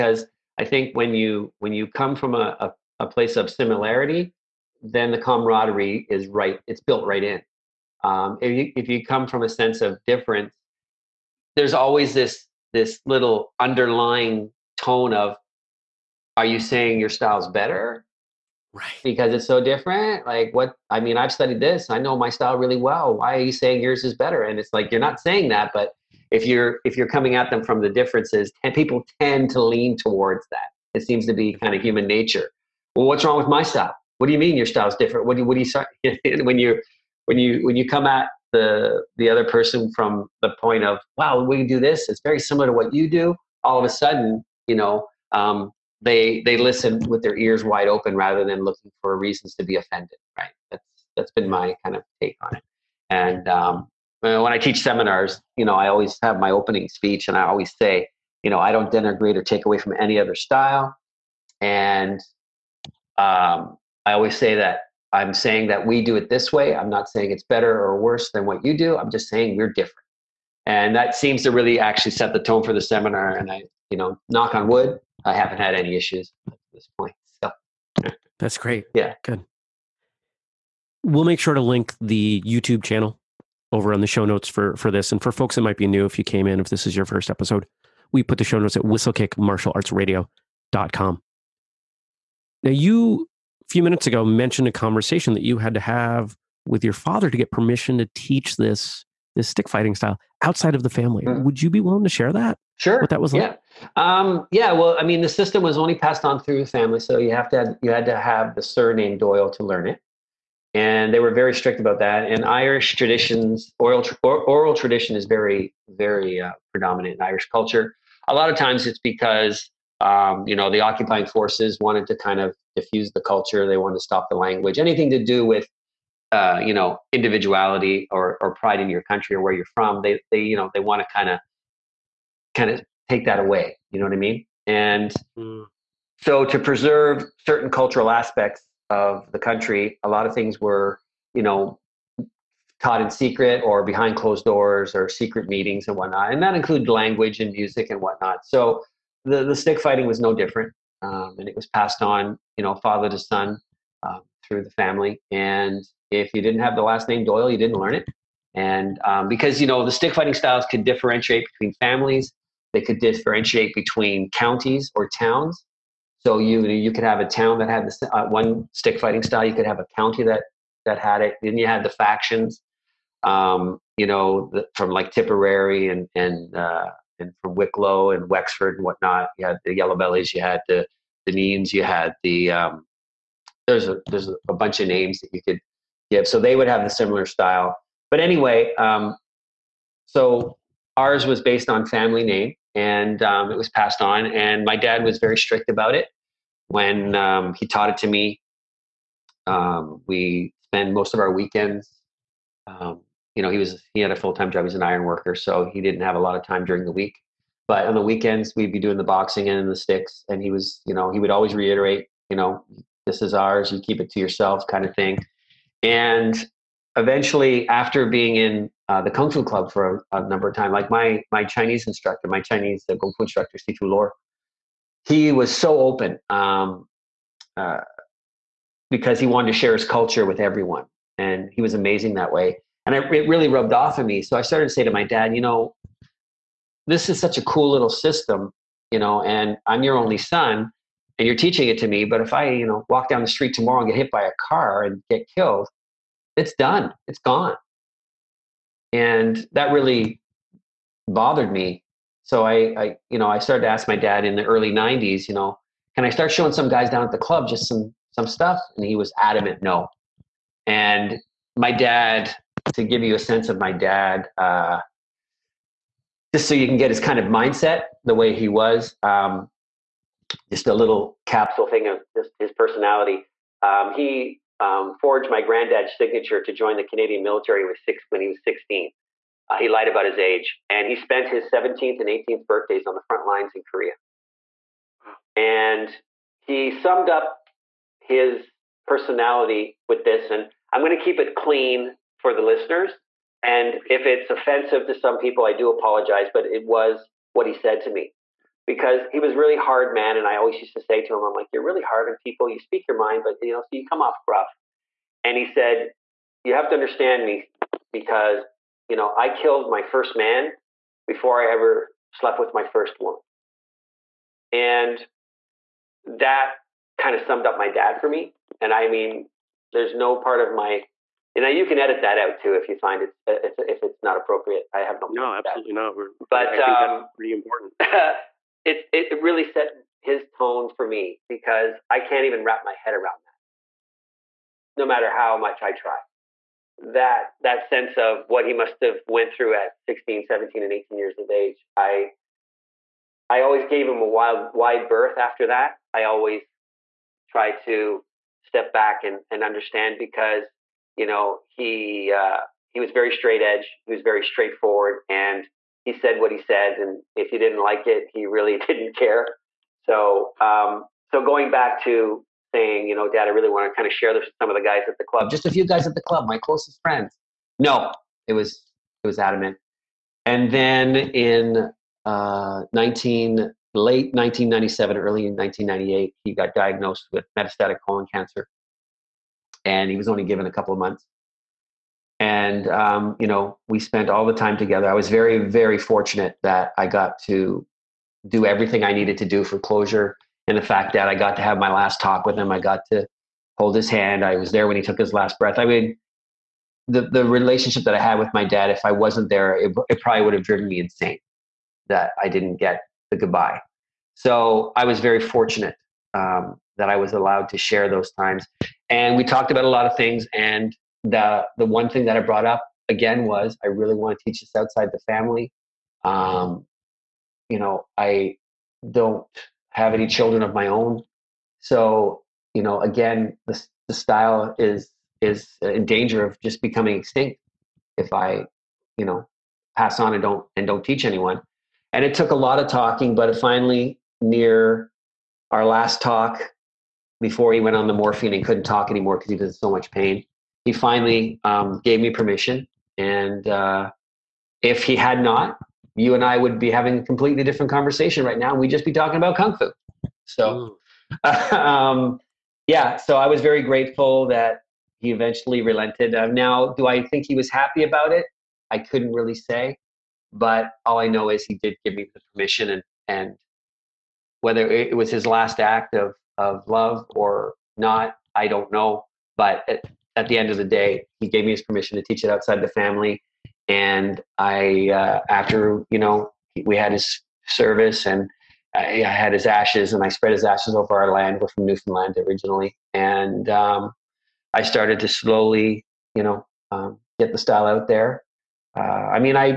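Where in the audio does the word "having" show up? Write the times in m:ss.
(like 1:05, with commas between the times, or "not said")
7:26.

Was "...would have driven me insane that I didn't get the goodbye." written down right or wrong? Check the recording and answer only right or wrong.
right.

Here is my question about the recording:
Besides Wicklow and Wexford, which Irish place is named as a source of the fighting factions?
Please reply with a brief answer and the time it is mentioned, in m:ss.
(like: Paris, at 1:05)
Tipperary, at 2:55.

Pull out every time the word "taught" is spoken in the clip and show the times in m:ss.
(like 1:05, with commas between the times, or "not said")
2:22, 3:17.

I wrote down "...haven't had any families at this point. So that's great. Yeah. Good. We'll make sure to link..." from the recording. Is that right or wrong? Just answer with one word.
wrong.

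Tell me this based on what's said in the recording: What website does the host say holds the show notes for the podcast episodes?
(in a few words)
whistlekickmartialartsradio.com.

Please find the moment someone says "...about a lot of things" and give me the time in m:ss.
6:49.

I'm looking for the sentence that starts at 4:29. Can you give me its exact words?
Um, just a little capsule thing of his, his personality.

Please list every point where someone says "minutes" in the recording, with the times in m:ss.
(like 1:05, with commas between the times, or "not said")
1:33.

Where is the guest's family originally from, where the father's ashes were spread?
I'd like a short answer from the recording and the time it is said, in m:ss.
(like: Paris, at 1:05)
Newfoundland, at 8:01.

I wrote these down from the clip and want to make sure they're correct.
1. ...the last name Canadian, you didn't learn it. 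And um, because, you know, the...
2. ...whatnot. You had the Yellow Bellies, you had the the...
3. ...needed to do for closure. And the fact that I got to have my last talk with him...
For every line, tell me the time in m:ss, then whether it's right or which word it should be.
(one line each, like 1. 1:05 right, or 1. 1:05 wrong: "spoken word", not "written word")
1. 2:36 wrong: "Doyle", not "Canadian"
2. 2:58 right
3. 6:28 right.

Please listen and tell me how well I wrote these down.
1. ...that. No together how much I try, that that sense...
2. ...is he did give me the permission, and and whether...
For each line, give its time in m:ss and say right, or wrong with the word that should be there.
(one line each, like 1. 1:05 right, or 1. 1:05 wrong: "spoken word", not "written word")
1. 5:33 wrong: "matter", not "together"
2. 7:41 right.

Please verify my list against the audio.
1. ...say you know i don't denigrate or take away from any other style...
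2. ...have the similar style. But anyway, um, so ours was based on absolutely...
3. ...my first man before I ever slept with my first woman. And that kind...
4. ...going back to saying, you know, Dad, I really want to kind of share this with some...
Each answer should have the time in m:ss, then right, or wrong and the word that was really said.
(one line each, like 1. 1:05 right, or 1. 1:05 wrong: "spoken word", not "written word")
1. 0:57 right
2. 3:06 wrong: "family", not "absolutely"
3. 5:09 right
4. 6:01 right.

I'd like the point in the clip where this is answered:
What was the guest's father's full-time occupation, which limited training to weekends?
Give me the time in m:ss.
3:24.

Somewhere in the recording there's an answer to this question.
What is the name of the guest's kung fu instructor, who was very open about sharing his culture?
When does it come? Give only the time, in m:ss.
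3:43.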